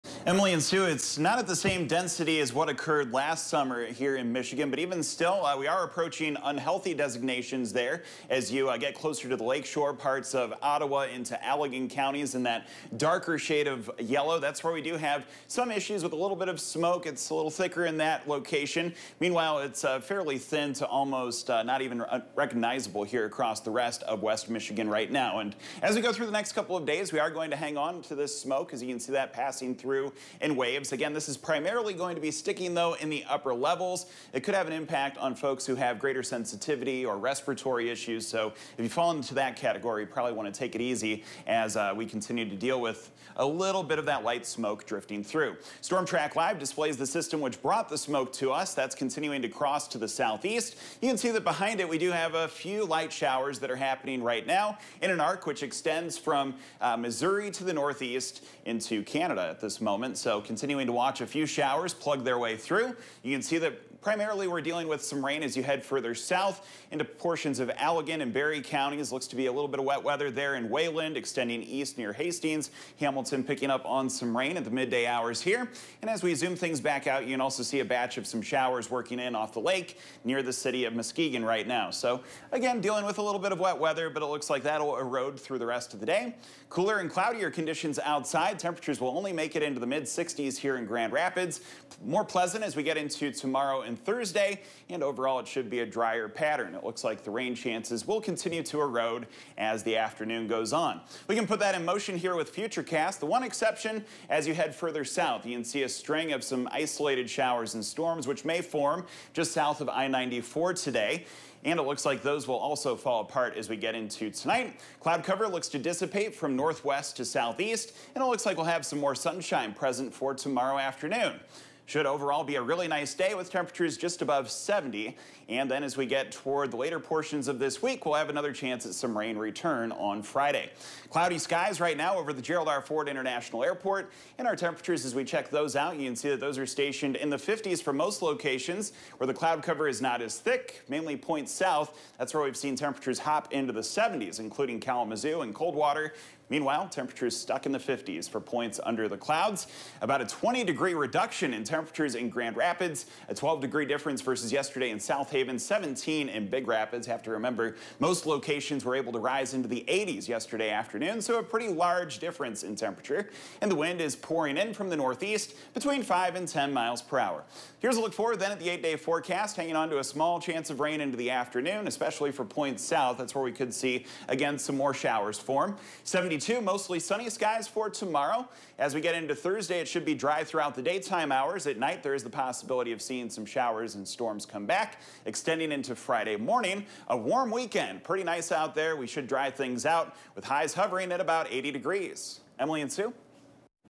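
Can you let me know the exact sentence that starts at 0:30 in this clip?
Again, this is primarily going to be sticking, though, in the upper levels.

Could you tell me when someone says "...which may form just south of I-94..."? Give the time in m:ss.
1:48.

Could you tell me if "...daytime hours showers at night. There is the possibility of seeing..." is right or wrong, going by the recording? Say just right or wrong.
right.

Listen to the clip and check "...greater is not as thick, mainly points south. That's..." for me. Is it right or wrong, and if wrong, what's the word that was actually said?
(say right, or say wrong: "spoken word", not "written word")
wrong: "cover", not "greater".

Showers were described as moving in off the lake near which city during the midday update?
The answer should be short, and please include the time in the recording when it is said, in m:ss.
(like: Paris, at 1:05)
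Muskegon, at 1:20.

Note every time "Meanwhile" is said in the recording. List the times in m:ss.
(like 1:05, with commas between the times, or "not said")
0:19, 2:26.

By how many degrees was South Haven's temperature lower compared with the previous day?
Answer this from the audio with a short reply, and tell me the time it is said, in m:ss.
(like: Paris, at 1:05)
12, at 2:33.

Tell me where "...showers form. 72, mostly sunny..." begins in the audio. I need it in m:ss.
2:54.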